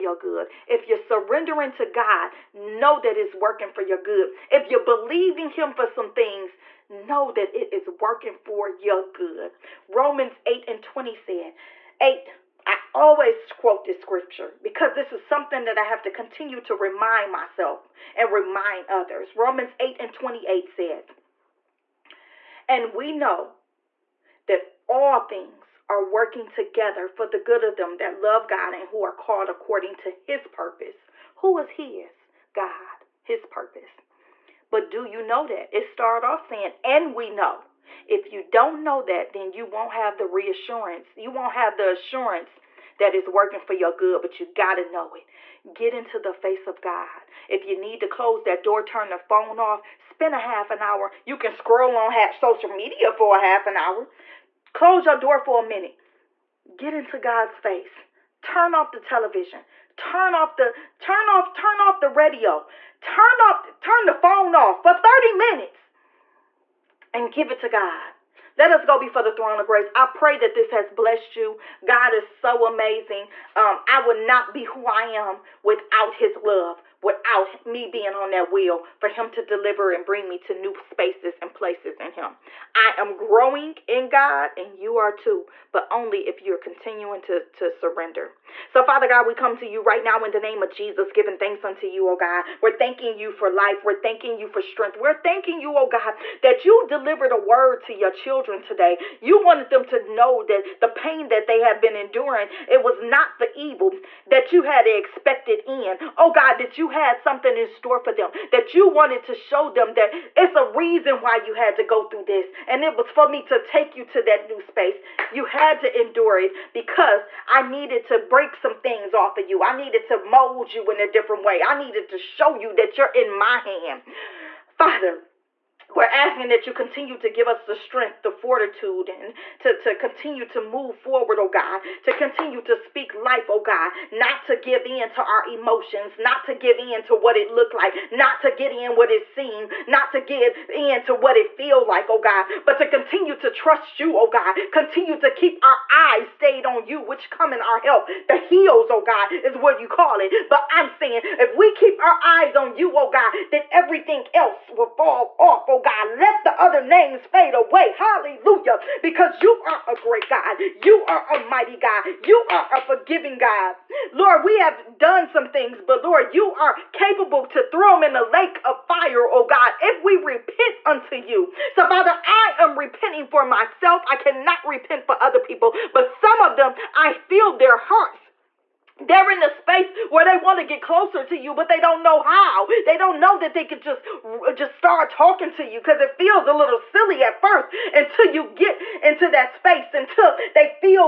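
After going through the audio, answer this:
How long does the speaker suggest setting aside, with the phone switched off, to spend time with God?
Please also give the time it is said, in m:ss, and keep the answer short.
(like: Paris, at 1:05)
30 minutes, at 1:04.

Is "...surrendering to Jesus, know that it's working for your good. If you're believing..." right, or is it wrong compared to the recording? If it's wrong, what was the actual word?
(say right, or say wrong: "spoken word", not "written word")
wrong: "God", not "Jesus".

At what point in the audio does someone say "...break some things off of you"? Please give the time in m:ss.
1:58.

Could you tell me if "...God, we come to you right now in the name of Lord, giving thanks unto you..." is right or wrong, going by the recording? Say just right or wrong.
wrong.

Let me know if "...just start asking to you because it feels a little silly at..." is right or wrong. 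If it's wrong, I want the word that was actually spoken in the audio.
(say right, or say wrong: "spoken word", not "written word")
wrong: "talking", not "asking".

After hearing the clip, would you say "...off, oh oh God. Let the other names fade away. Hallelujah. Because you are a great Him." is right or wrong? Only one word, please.
wrong.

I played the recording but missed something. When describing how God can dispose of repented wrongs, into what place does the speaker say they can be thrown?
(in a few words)
the lake of fire.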